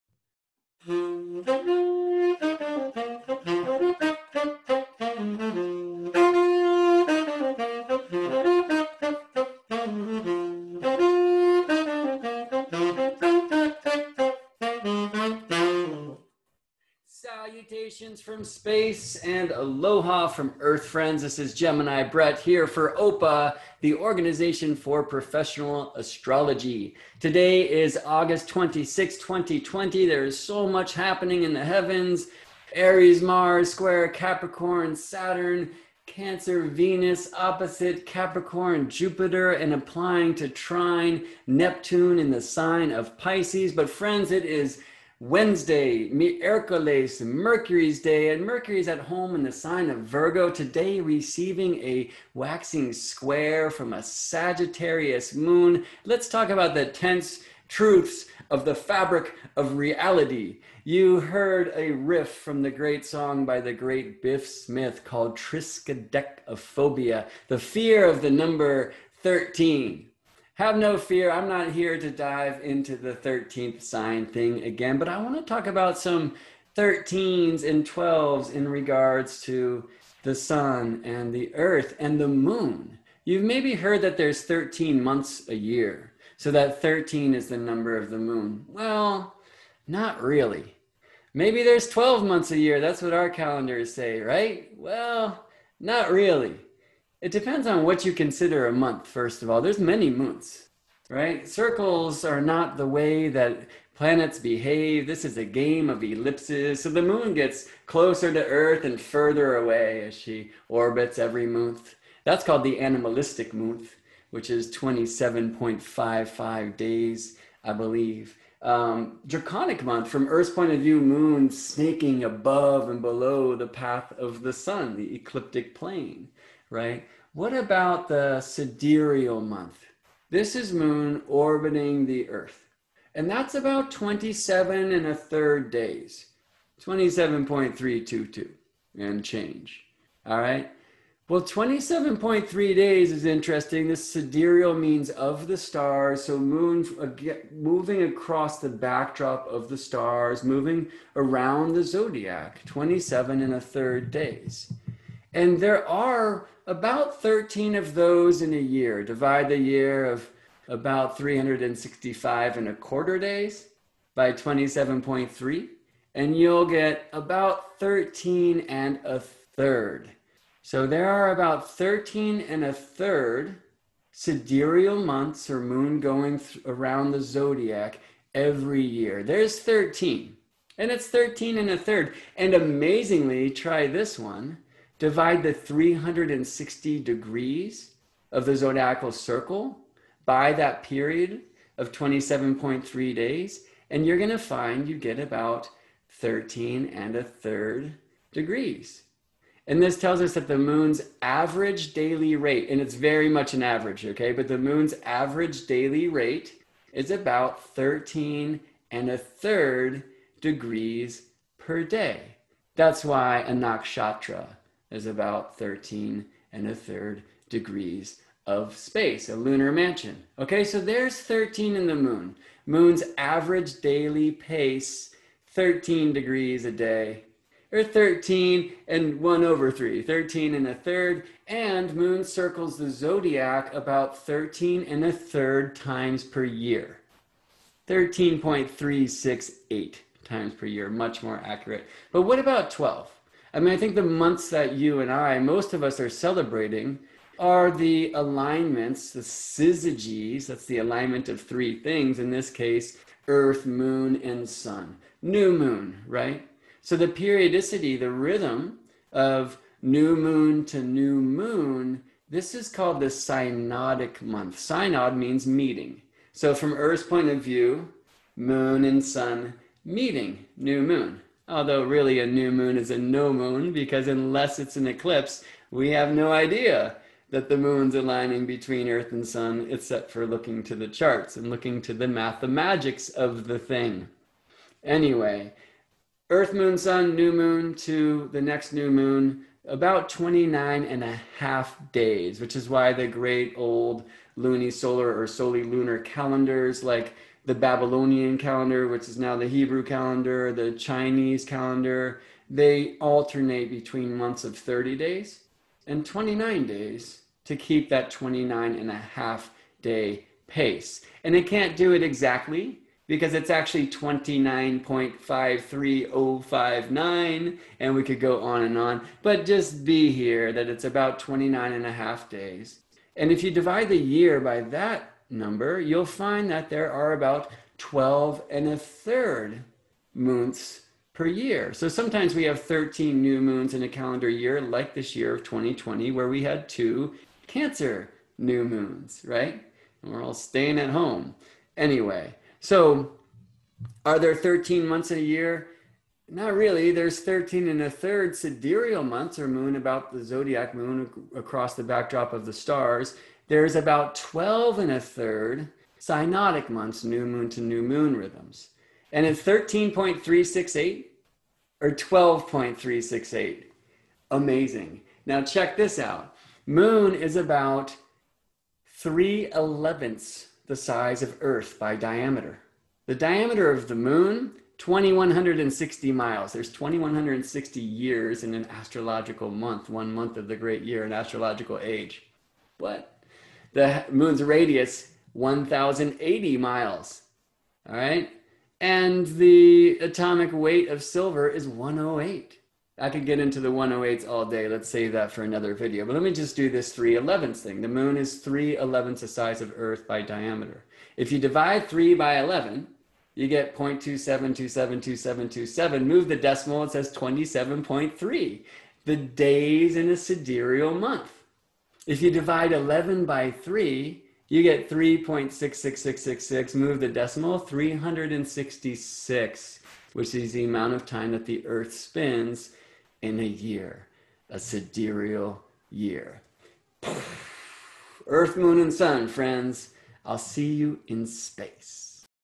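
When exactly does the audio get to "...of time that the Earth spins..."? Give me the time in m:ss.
7:00.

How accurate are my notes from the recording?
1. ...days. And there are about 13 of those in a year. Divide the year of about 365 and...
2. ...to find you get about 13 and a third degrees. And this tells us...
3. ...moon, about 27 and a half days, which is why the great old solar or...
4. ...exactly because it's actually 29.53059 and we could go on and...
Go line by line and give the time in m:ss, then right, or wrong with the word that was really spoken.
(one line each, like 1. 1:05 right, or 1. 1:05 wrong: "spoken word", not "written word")
1. 2:34 right
2. 3:14 right
3. 4:48 wrong: "29", not "27"
4. 5:12 right.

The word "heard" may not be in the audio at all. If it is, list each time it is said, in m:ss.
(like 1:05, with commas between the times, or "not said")
1:01, 1:23.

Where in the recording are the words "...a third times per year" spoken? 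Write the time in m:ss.
3:55.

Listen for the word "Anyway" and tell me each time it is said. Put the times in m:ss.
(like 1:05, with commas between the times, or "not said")
4:44, 5:41.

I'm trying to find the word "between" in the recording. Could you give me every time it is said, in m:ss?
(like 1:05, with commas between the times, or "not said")
4:38, 5:03.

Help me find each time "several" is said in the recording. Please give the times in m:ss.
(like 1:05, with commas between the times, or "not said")
not said.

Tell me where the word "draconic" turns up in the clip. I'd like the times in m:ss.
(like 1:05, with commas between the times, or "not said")
1:59.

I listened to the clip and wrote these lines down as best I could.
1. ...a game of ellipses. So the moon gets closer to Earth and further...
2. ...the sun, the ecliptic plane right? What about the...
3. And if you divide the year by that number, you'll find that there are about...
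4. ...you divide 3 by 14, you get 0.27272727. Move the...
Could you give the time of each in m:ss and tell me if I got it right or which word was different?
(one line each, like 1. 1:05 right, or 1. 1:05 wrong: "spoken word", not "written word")
1. 1:45 right
2. 2:04 right
3. 5:23 right
4. 6:41 wrong: "11", not "14".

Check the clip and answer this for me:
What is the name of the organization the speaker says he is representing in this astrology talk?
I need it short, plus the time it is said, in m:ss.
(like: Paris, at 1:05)
Organization for Professional Astrology, at 0:23.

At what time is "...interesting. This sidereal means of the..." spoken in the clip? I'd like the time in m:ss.
2:23.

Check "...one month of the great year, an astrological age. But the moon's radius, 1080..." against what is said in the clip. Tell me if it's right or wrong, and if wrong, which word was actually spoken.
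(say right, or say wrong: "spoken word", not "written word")
right.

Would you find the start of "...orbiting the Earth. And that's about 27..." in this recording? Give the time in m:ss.
2:11.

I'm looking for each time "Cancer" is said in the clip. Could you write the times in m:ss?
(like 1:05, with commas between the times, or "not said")
0:36, 5:37.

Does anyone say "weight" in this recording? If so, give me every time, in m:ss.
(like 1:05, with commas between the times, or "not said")
6:30.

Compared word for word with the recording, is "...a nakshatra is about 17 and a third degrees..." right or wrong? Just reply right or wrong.
wrong.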